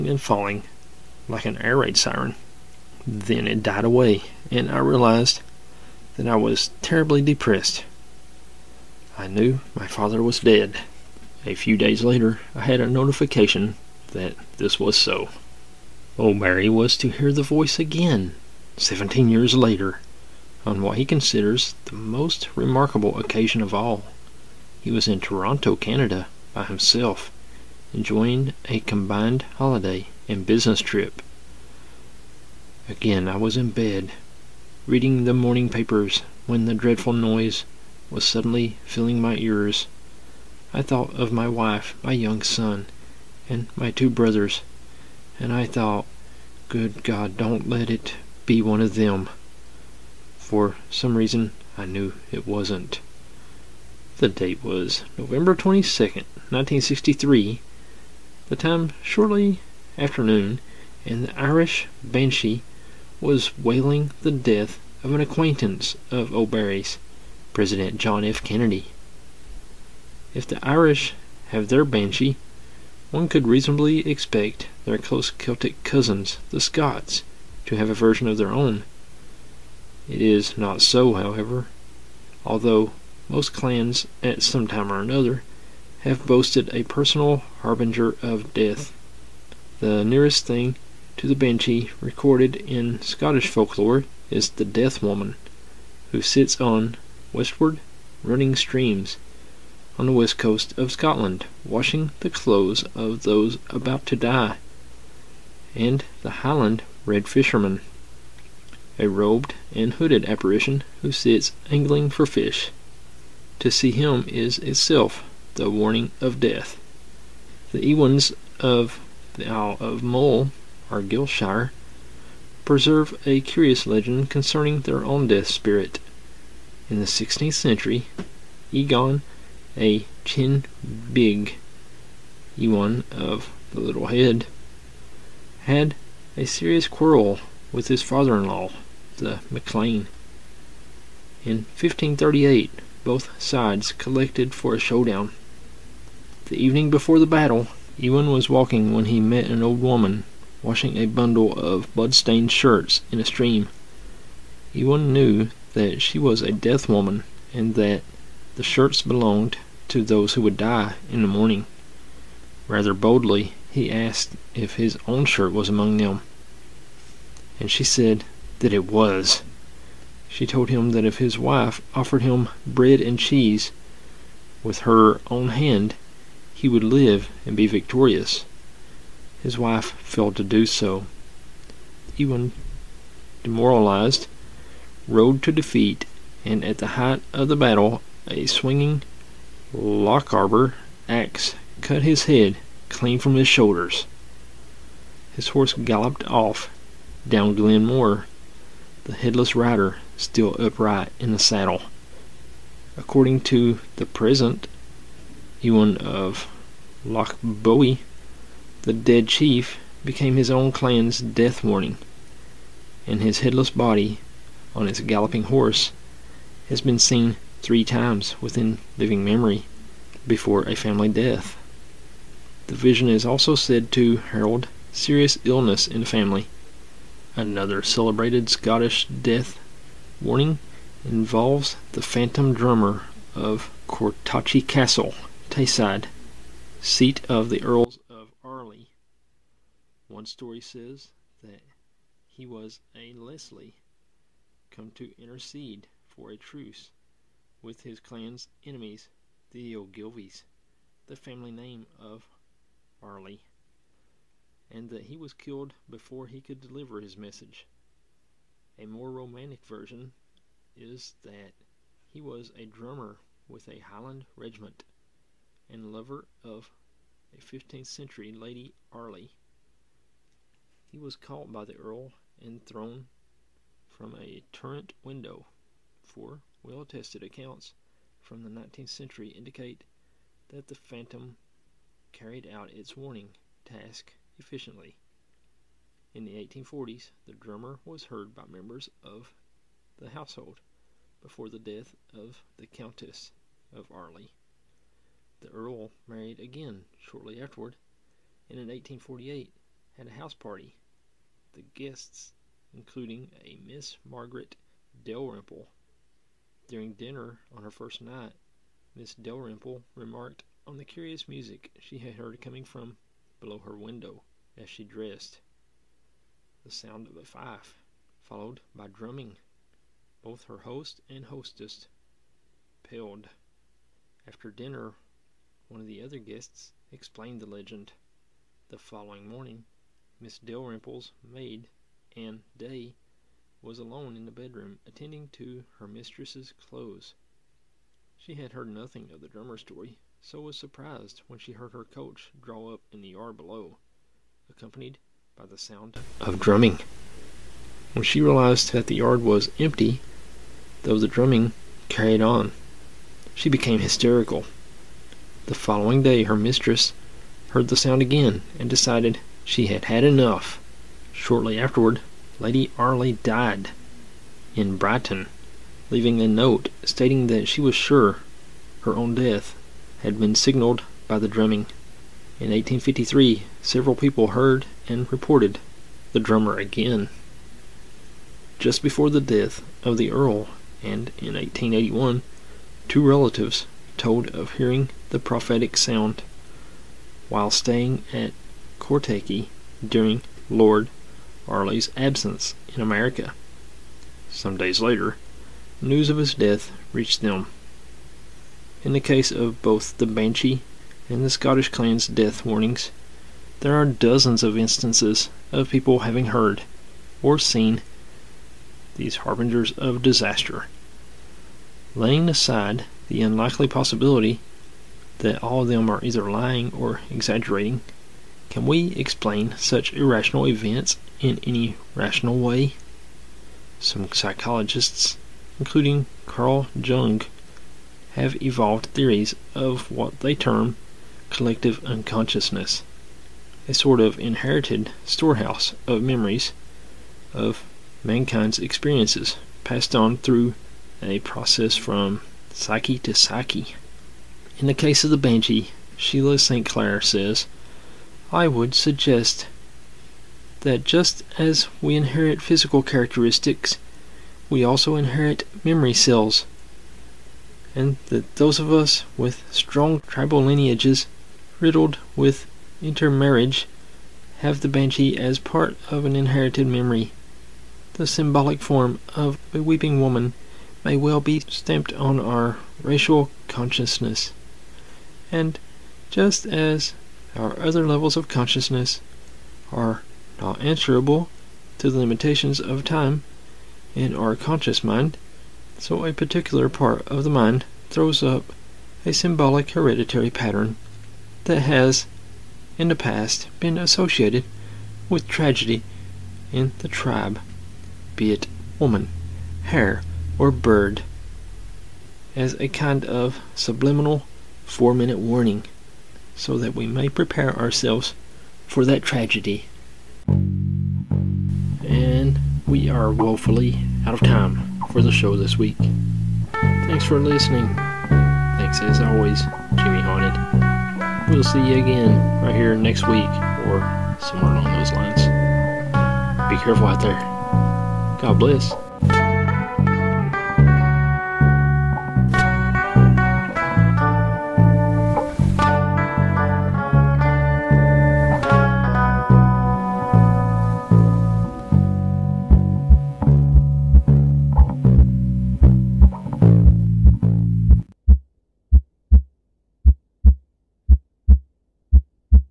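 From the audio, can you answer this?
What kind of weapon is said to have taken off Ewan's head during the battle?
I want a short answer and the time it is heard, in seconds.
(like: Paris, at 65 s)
Lochaber axe, at 189 s.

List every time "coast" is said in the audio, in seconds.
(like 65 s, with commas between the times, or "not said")
100 s.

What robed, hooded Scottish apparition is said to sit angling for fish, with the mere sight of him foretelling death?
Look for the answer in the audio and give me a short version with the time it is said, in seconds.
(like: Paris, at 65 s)
Highland Red Fisherman, at 106 s.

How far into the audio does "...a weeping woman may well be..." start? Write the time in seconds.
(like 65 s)
469 s.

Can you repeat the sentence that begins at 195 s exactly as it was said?
His horse galloped off down Glen Moor, the headless rider still upright in the saddle.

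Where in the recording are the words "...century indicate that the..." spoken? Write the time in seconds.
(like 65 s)
278 s.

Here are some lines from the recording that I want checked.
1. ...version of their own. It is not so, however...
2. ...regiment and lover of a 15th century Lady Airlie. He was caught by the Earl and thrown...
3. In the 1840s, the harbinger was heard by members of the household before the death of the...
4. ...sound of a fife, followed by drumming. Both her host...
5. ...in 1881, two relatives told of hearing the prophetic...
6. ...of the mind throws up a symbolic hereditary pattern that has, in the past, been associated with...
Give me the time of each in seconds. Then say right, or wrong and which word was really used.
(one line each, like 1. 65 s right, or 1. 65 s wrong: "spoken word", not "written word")
1. 77 s right
2. 264 s right
3. 286 s wrong: "drummer", not "harbinger"
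4. 316 s right
5. 381 s right
6. 487 s right.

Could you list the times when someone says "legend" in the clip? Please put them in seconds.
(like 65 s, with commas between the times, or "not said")
123 s, 327 s.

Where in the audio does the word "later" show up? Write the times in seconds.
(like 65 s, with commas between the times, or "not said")
12 s, 19 s, 394 s.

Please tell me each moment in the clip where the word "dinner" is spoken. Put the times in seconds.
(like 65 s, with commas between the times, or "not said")
306 s, 324 s.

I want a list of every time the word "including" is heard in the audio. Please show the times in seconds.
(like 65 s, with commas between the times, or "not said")
302 s, 425 s.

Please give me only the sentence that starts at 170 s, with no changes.
She told him that if his wife offered him bread and cheese with her own hand, he would live and be victorious.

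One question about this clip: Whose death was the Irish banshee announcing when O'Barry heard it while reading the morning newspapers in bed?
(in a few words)
John F. Kennedy.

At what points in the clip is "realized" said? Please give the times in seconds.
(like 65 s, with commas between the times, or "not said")
4 s, 348 s.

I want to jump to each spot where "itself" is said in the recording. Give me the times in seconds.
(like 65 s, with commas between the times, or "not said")
114 s.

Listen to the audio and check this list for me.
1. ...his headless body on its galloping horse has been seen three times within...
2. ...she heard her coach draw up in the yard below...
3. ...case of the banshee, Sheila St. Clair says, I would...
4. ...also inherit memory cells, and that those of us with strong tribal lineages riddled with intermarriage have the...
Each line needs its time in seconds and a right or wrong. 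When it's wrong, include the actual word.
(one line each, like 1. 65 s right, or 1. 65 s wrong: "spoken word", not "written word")
1. 213 s right
2. 341 s right
3. 444 s right
4. 454 s right.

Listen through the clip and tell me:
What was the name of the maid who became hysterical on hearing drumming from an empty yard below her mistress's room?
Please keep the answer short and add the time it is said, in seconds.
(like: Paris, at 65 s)
Anne Day, at 332 s.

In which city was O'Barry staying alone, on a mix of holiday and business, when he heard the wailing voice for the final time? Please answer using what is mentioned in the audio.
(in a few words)
Toronto.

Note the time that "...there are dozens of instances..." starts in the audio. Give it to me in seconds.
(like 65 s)
403 s.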